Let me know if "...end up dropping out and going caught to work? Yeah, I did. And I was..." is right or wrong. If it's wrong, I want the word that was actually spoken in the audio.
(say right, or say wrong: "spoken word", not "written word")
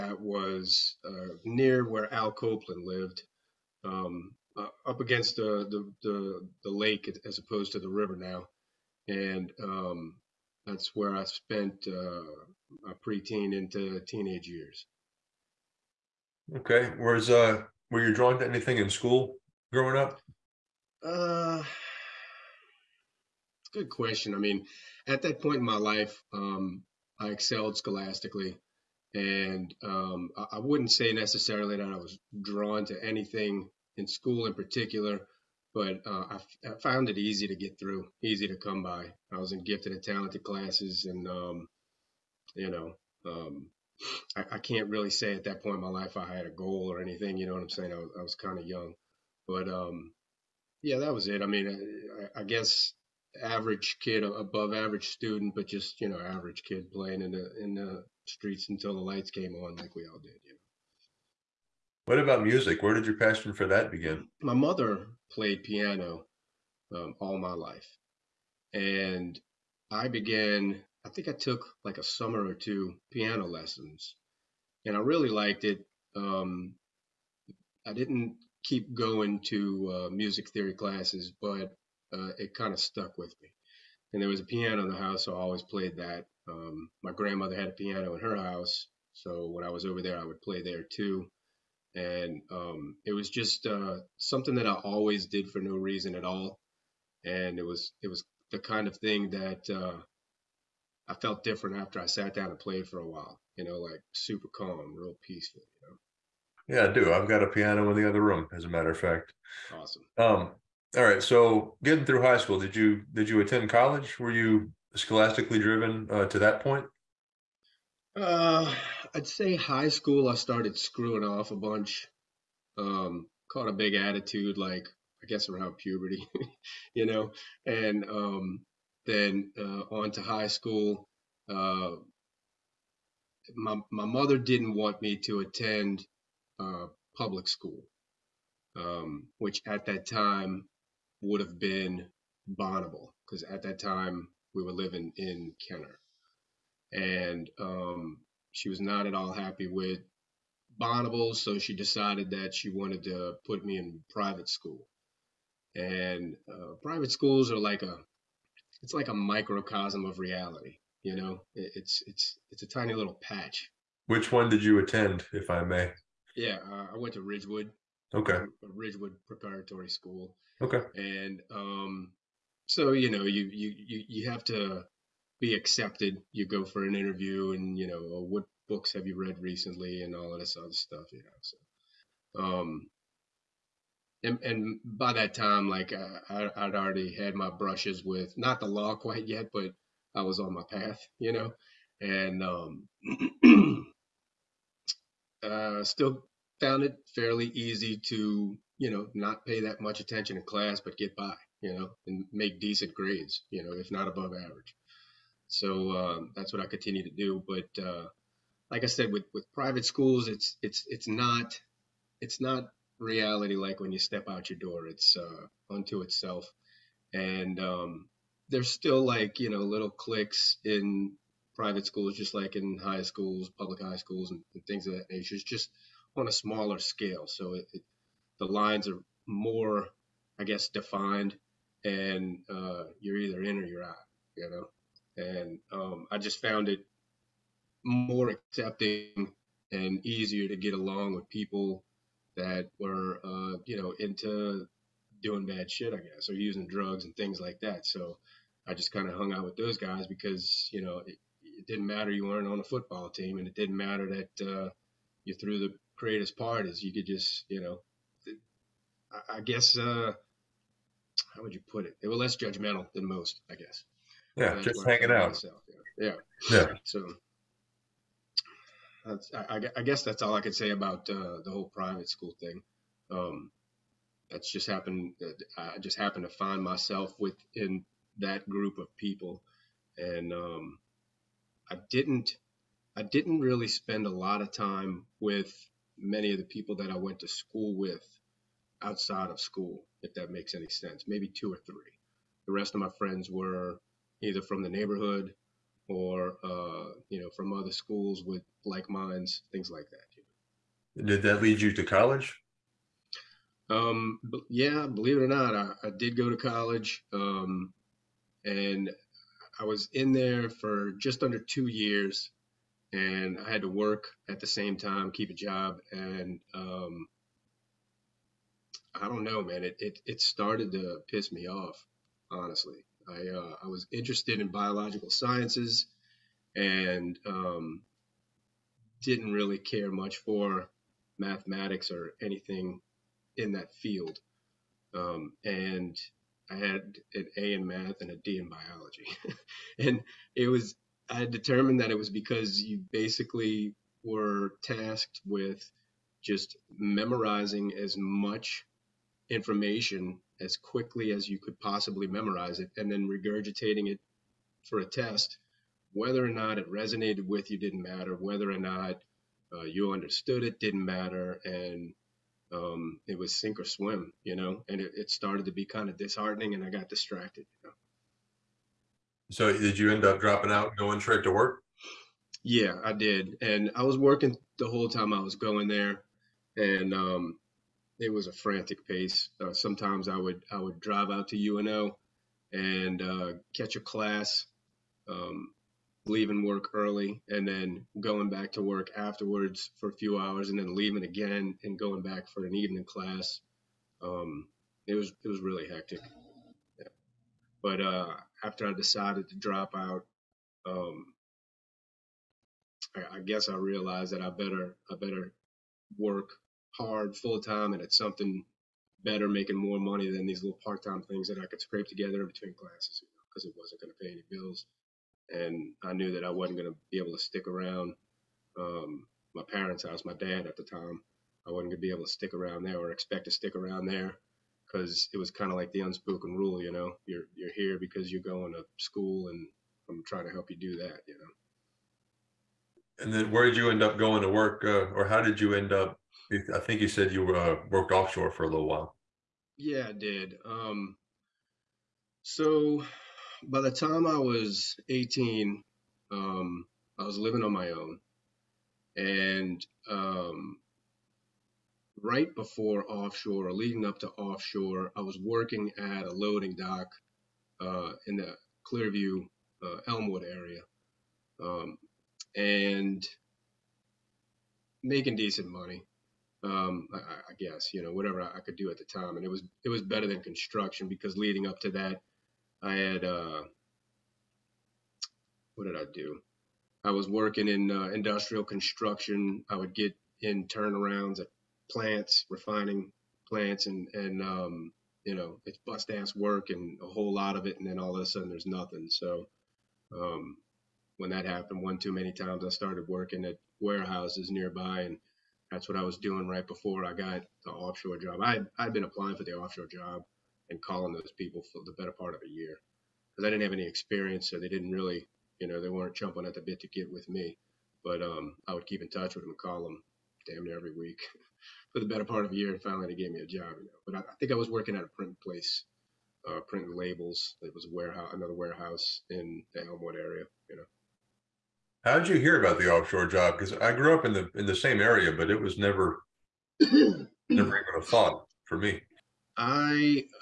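wrong: "straight", not "caught".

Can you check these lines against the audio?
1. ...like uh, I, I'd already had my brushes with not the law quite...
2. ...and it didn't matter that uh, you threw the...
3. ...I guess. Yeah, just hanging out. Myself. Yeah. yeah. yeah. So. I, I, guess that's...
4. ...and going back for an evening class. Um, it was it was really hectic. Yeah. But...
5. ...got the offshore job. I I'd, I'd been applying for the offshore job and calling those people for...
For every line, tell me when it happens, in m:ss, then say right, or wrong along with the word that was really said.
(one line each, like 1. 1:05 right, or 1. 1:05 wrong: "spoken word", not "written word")
1. 3:05 right
2. 4:13 right
3. 4:23 right
4. 6:31 right
5. 8:16 right.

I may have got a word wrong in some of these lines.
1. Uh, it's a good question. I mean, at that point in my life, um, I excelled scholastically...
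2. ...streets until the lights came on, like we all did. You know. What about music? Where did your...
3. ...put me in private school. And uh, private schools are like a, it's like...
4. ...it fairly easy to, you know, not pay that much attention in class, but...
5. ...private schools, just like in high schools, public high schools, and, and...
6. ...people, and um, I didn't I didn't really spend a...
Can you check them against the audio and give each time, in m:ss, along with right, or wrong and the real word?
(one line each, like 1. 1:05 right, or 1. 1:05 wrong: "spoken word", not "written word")
1. 0:21 right
2. 0:58 right
3. 2:33 right
4. 3:16 right
5. 3:41 right
6. 4:38 right.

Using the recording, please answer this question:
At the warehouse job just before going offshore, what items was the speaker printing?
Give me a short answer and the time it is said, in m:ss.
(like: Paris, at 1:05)
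labels, at 8:36.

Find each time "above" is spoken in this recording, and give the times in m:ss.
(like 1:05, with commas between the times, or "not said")
0:54, 3:24.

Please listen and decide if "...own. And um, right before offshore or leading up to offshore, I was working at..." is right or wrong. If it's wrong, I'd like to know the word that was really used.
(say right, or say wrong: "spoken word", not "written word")
right.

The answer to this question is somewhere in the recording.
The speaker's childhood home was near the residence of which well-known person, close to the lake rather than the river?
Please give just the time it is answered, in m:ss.
0:02.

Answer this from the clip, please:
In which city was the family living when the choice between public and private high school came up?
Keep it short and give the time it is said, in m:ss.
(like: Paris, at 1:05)
Kenner, at 2:25.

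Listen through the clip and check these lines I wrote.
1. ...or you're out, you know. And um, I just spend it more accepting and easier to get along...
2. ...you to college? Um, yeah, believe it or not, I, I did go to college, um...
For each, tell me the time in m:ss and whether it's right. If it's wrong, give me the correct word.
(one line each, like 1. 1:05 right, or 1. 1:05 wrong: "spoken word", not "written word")
1. 3:53 wrong: "found", not "spend"
2. 5:01 right.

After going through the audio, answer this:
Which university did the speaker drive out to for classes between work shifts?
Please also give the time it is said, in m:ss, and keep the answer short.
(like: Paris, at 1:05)
UNO, at 6:21.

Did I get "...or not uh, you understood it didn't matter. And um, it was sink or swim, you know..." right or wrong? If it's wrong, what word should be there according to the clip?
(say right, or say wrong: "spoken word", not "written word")
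right.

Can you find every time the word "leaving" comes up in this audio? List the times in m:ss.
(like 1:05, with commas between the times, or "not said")
6:26, 6:30.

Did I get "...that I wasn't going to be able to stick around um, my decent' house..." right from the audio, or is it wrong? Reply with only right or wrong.
wrong.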